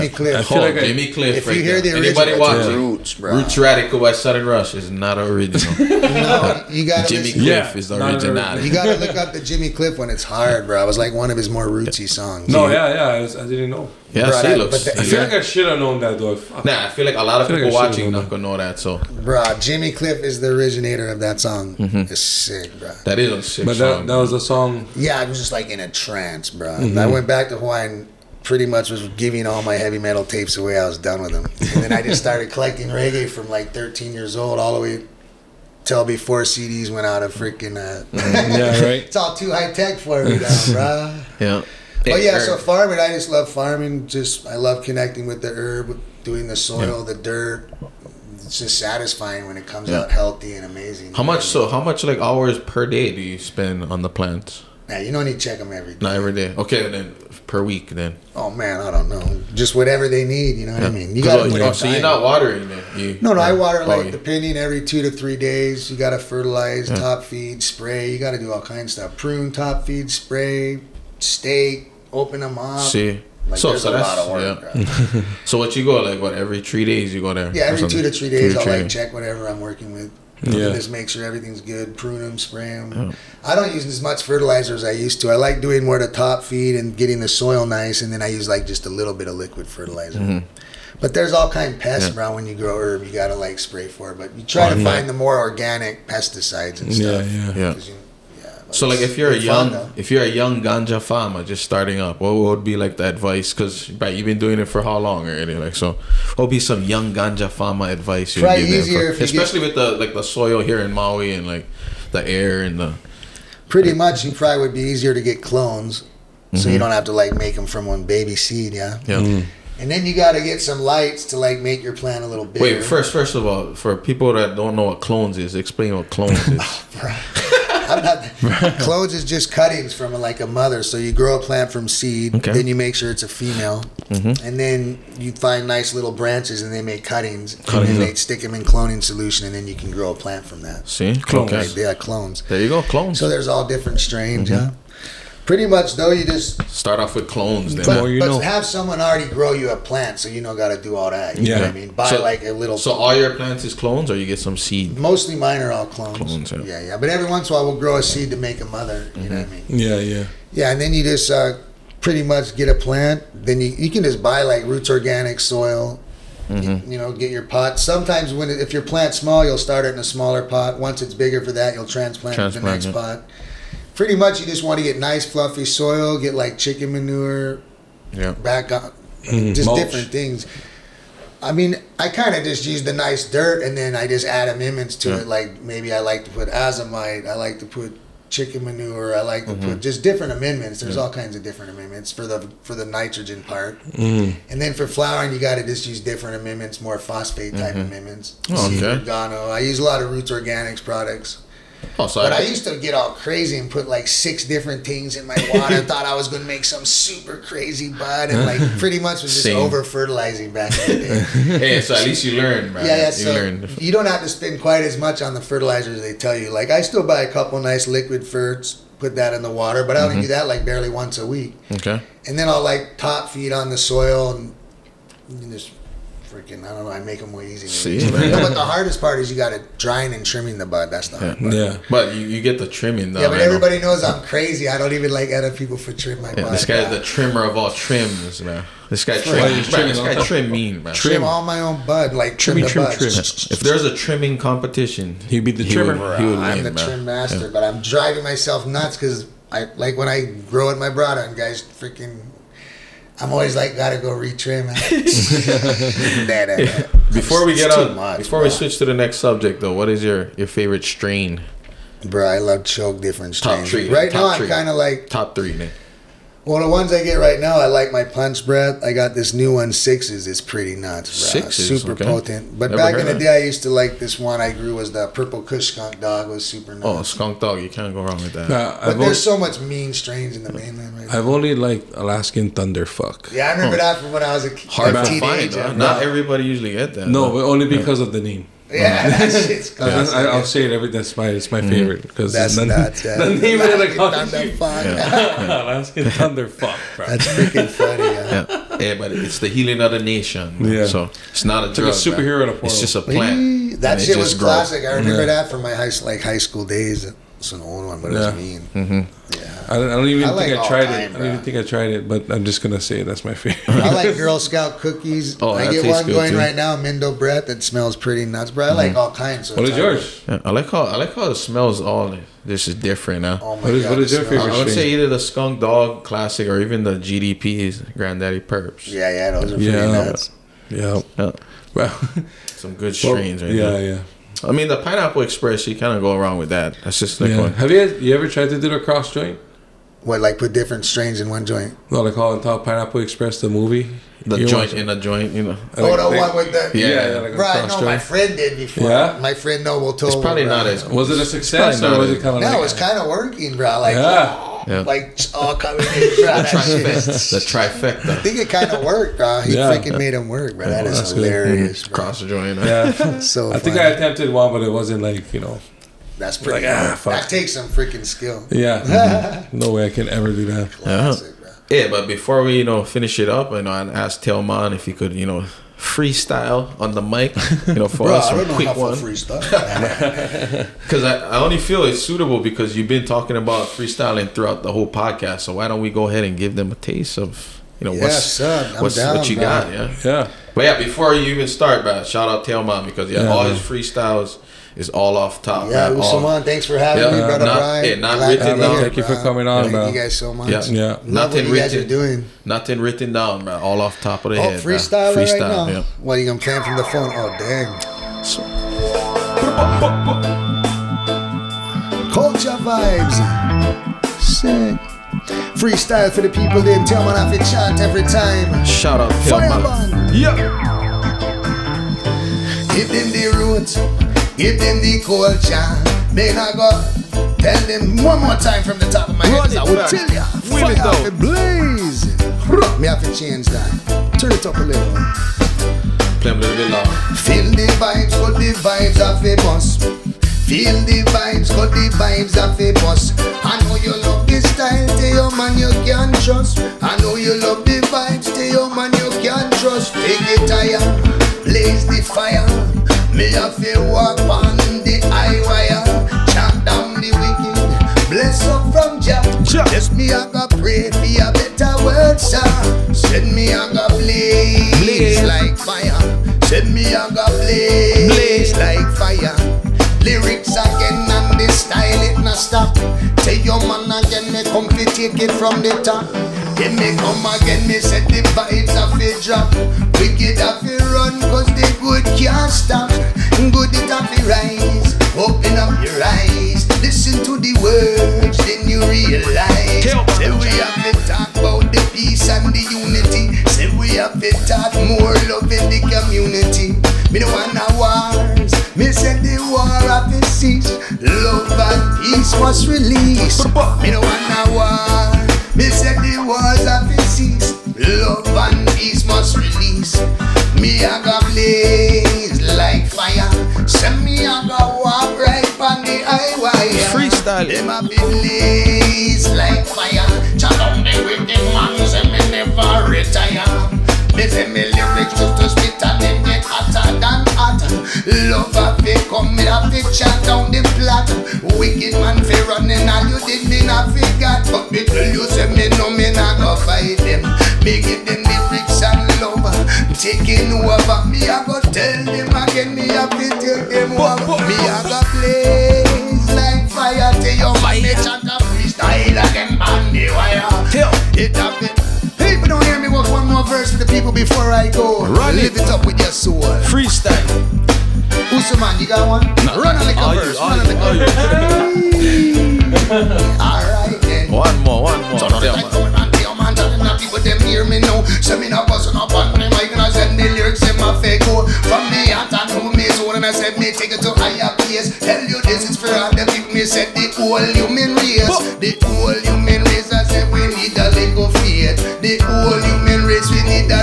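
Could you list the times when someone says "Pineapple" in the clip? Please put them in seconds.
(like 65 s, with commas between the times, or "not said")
334 s, 342 s.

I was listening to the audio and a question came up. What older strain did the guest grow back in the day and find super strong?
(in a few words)
Purple Kush Skunk Dog.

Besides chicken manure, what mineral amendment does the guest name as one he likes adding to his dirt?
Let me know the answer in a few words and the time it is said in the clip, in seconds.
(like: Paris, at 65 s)
Azomite, at 186 s.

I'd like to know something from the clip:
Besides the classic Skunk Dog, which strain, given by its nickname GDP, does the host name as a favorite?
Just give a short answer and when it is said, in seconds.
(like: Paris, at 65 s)
Granddaddy Purps, at 327 s.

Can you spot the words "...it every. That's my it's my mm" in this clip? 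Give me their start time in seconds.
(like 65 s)
290 s.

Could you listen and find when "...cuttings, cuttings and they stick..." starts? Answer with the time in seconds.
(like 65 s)
137 s.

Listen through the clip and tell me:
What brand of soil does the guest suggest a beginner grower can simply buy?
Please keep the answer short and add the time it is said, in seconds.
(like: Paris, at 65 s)
Roots Organic, at 164 s.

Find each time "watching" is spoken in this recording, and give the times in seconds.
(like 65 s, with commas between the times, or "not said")
2 s, 17 s.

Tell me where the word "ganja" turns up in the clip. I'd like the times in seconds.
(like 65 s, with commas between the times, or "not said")
100 s, 107 s.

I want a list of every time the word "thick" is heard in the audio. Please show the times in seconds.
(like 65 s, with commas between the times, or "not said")
not said.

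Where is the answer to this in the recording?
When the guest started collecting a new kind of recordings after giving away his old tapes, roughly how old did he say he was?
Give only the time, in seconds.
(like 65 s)
33 s.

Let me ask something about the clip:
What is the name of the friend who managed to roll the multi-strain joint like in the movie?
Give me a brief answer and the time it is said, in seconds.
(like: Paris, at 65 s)
Noble, at 349 s.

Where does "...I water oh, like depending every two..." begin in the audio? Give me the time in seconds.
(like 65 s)
63 s.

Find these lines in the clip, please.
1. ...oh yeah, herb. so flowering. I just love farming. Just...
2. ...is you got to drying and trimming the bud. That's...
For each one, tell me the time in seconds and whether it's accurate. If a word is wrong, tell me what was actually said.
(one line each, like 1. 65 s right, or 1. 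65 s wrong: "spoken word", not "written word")
1. 42 s wrong: "farming", not "flowering"
2. 229 s right.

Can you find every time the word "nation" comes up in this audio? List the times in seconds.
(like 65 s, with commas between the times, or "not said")
299 s.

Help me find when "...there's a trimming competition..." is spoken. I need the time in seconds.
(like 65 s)
243 s.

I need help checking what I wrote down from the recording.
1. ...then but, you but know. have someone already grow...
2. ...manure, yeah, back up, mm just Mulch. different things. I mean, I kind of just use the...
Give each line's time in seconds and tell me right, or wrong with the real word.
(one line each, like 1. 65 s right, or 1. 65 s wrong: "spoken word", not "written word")
1. 147 s right
2. 176 s right.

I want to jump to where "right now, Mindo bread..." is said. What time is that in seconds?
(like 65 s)
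316 s.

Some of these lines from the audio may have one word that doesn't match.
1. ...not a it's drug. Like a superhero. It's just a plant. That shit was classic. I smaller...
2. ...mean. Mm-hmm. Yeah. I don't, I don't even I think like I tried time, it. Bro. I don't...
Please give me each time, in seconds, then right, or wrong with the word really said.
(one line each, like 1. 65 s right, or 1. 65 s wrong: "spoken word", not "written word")
1. 301 s wrong: "remember", not "smaller"
2. 308 s right.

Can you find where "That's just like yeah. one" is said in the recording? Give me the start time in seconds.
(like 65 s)
336 s.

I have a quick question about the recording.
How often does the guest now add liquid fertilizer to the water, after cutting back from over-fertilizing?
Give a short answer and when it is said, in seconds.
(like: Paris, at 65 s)
Barely once a week, at 220 s.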